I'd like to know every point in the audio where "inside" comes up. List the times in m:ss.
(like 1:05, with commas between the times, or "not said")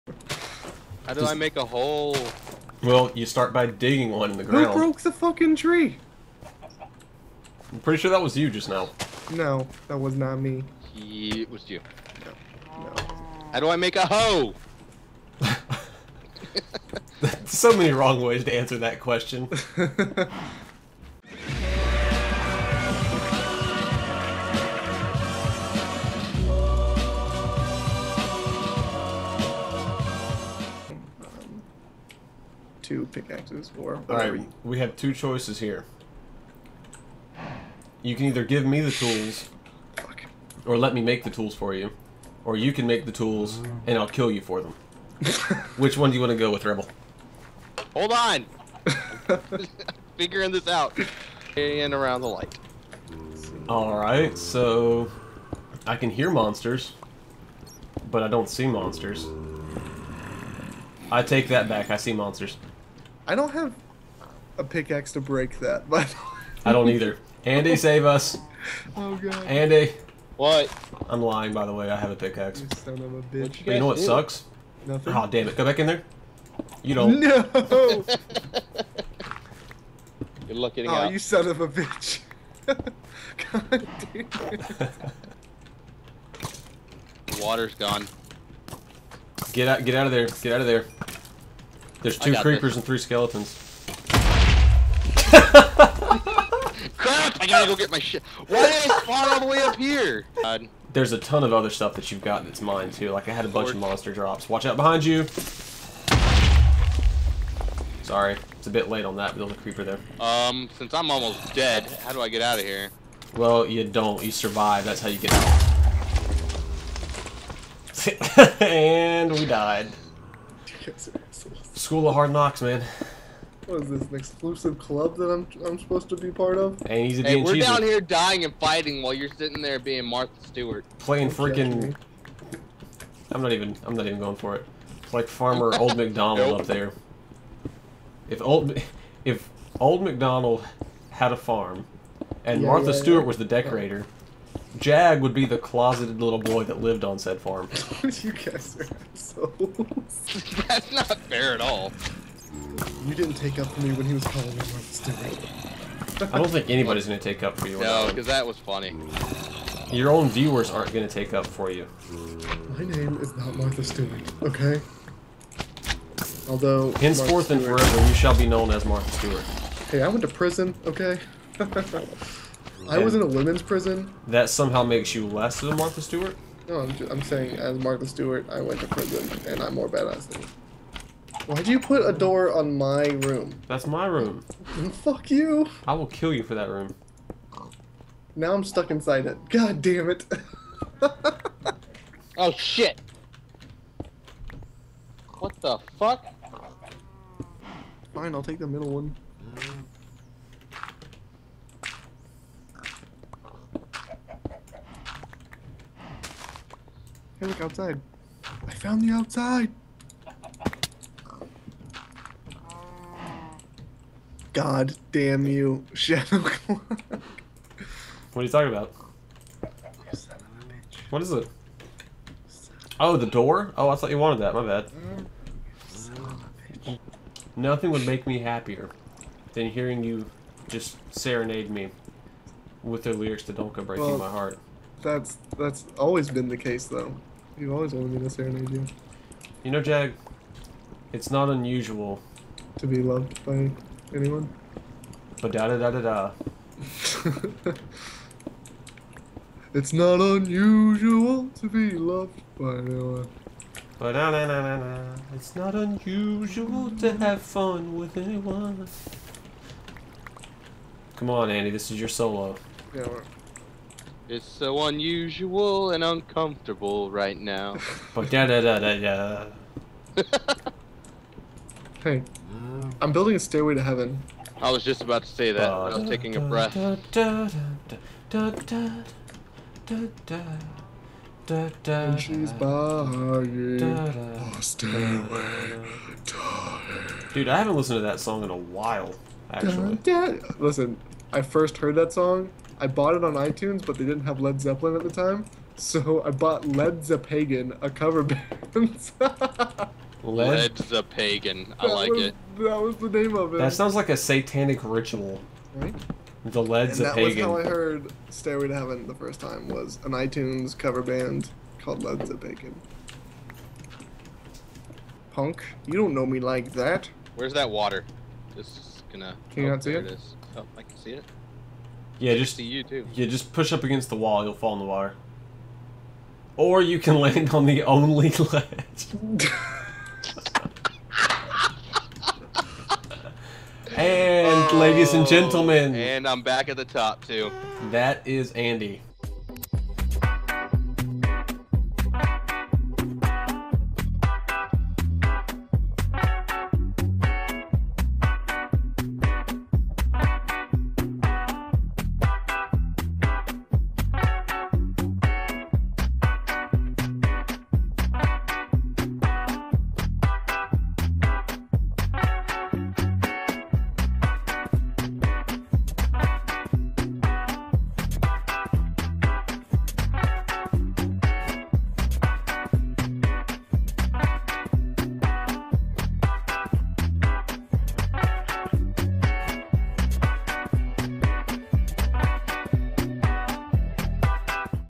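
3:08.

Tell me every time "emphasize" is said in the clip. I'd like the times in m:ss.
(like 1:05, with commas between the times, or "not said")
not said.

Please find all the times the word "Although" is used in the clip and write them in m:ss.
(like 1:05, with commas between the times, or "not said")
2:46.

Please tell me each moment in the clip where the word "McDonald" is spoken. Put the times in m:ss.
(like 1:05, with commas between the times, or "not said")
2:15, 2:20.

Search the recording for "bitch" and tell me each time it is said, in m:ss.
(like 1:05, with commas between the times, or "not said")
1:13, 1:21.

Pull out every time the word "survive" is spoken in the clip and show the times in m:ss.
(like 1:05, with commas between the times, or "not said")
1:54.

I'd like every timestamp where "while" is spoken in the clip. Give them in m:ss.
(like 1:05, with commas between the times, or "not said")
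2:09, 4:48.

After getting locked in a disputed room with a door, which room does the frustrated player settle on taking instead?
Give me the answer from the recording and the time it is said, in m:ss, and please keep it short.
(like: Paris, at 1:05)
The middle one, at 3:18.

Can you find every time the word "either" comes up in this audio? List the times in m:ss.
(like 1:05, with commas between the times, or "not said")
0:38, 1:06.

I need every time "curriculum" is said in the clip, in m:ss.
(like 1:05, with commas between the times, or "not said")
not said.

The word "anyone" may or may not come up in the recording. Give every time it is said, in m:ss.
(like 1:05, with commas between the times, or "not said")
4:04, 4:12, 4:18.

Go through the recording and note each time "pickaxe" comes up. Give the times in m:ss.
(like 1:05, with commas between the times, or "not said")
0:33, 1:04, 1:12.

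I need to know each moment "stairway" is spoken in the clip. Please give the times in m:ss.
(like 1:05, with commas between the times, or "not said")
4:33, 4:44, 5:08.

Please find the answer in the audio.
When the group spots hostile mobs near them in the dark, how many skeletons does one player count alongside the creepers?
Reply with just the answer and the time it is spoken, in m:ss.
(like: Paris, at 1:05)
3, at 1:32.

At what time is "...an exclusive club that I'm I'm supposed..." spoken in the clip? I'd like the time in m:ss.
2:04.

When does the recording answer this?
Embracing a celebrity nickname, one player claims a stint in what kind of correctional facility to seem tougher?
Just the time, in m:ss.
2:53.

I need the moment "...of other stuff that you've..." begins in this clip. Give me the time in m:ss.
1:41.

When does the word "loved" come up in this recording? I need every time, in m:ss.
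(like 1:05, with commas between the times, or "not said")
4:03, 4:11.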